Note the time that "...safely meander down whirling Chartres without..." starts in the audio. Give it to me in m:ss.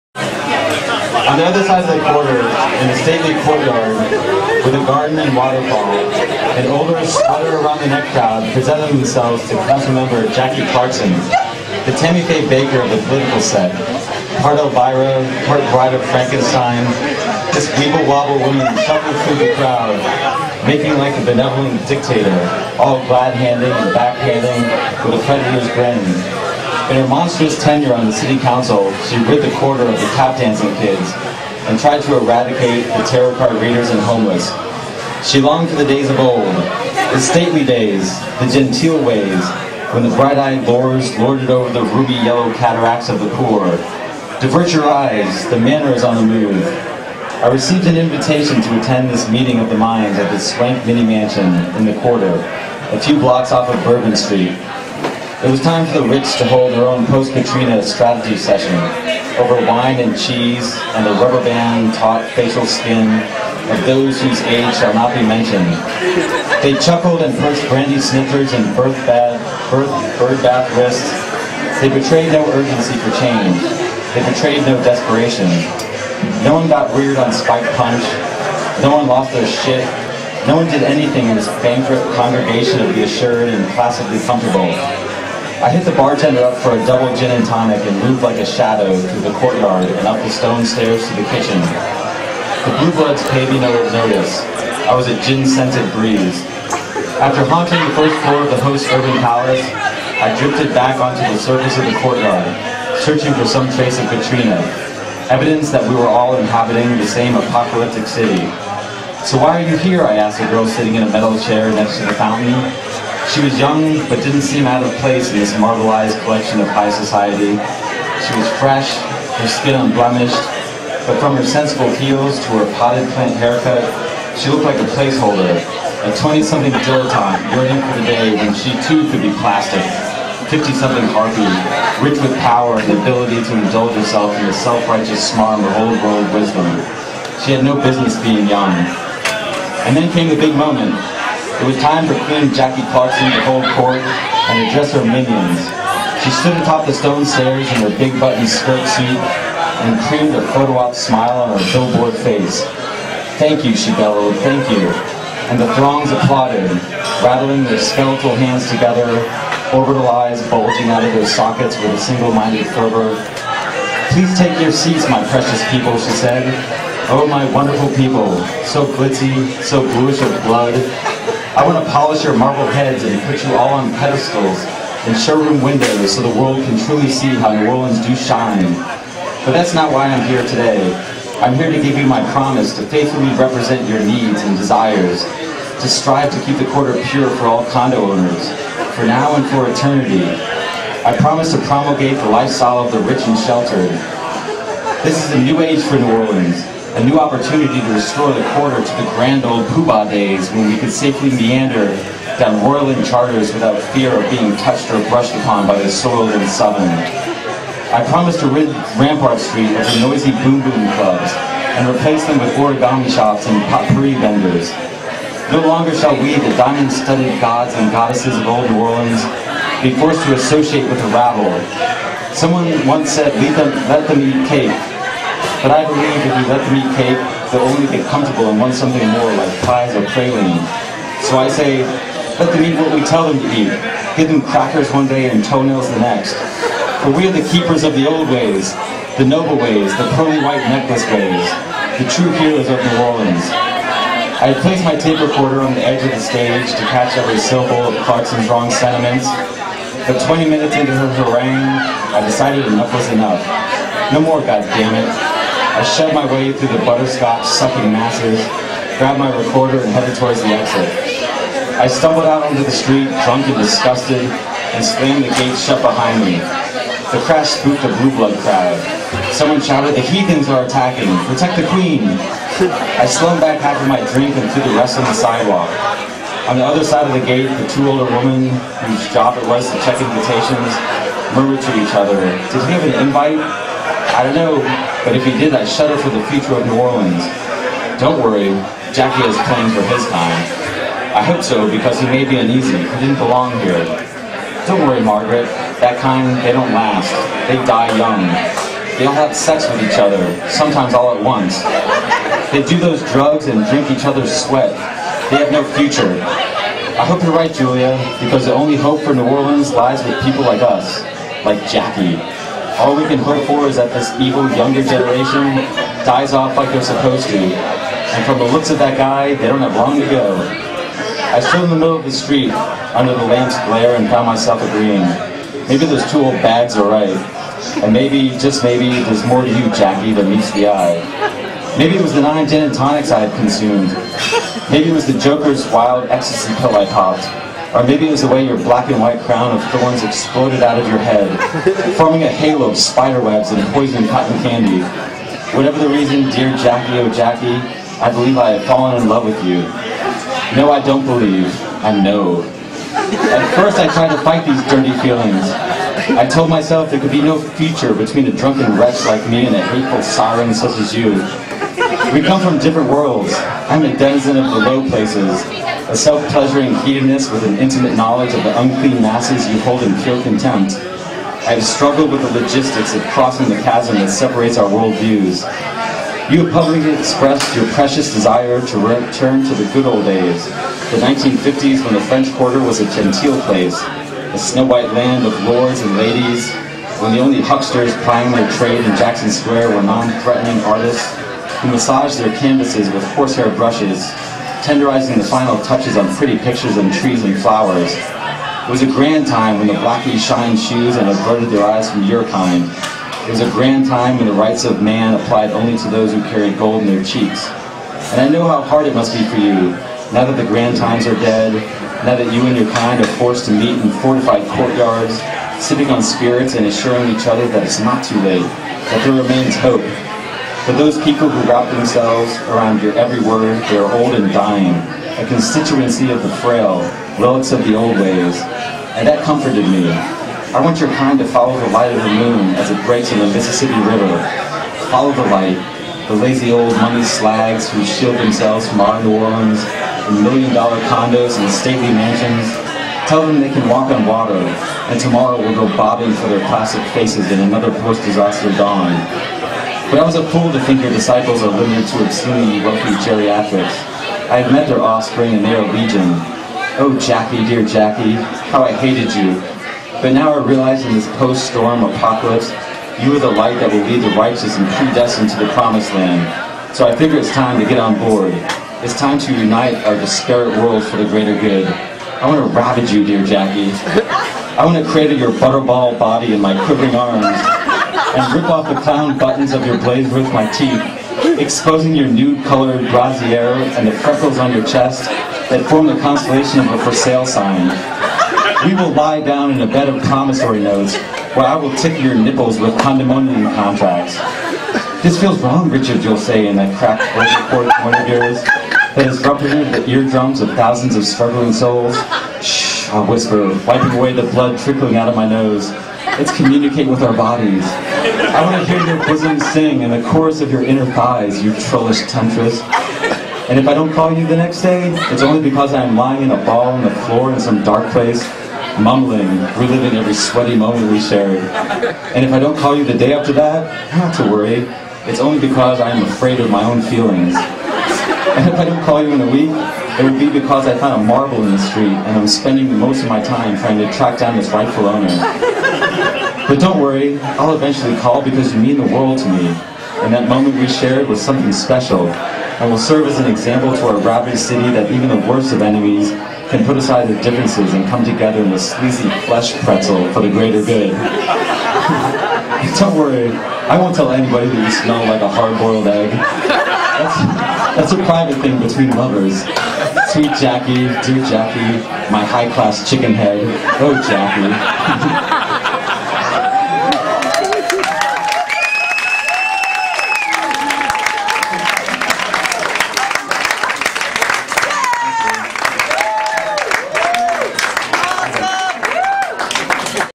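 3:20.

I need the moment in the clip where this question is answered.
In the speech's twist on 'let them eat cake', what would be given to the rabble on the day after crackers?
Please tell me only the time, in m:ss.
3:55.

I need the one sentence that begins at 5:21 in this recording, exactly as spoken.
I stood in the middle of the street under the lamp's glare and found myself agreeing.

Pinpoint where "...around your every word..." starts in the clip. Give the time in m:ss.
7:02.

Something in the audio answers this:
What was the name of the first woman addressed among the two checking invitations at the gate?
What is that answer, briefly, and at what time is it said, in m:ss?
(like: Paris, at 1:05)
Margaret, at 4:55.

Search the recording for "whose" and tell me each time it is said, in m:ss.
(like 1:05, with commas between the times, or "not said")
1:04, 4:38.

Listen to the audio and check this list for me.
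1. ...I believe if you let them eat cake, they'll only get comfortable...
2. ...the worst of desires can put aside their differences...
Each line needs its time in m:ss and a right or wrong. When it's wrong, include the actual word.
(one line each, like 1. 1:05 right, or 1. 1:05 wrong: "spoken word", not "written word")
1. 3:45 right
2. 9:05 wrong: "enemies", not "desires".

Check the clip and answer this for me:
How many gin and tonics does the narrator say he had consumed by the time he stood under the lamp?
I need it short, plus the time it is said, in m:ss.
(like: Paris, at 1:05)
9, at 5:32.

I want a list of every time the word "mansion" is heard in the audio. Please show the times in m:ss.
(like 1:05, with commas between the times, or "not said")
0:51, 7:21.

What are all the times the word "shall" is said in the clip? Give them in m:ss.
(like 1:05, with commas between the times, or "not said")
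1:04, 3:35.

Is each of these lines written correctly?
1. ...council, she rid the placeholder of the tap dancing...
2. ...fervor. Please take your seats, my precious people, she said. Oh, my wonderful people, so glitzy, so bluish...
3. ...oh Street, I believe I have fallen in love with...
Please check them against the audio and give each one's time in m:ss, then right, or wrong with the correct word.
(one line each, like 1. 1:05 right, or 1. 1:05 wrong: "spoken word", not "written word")
1. 0:28 wrong: "quarter", not "placeholder"
2. 2:42 right
3. 5:46 wrong: "Jackie", not "Street".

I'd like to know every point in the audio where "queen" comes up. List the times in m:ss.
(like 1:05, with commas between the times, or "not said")
2:22, 4:31.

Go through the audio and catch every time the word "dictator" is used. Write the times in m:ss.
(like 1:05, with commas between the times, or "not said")
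0:21.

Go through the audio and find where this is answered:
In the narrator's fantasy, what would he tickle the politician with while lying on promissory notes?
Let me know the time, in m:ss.
8:12.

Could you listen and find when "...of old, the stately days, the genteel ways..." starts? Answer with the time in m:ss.
0:36.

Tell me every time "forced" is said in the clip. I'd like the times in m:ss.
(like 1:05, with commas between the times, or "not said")
3:39, 6:53.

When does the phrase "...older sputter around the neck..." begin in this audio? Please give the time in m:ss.
0:06.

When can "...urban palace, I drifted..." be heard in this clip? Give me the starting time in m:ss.
1:38.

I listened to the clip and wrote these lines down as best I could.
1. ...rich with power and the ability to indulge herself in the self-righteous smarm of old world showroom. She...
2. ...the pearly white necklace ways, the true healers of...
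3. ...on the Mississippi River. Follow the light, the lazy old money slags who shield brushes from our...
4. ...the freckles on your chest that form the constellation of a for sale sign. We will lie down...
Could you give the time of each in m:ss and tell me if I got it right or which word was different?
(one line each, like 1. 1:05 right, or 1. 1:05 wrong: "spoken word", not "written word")
1. 2:12 wrong: "wisdom", not "showroom"
2. 4:00 right
3. 7:13 wrong: "themselves", not "brushes"
4. 8:03 right.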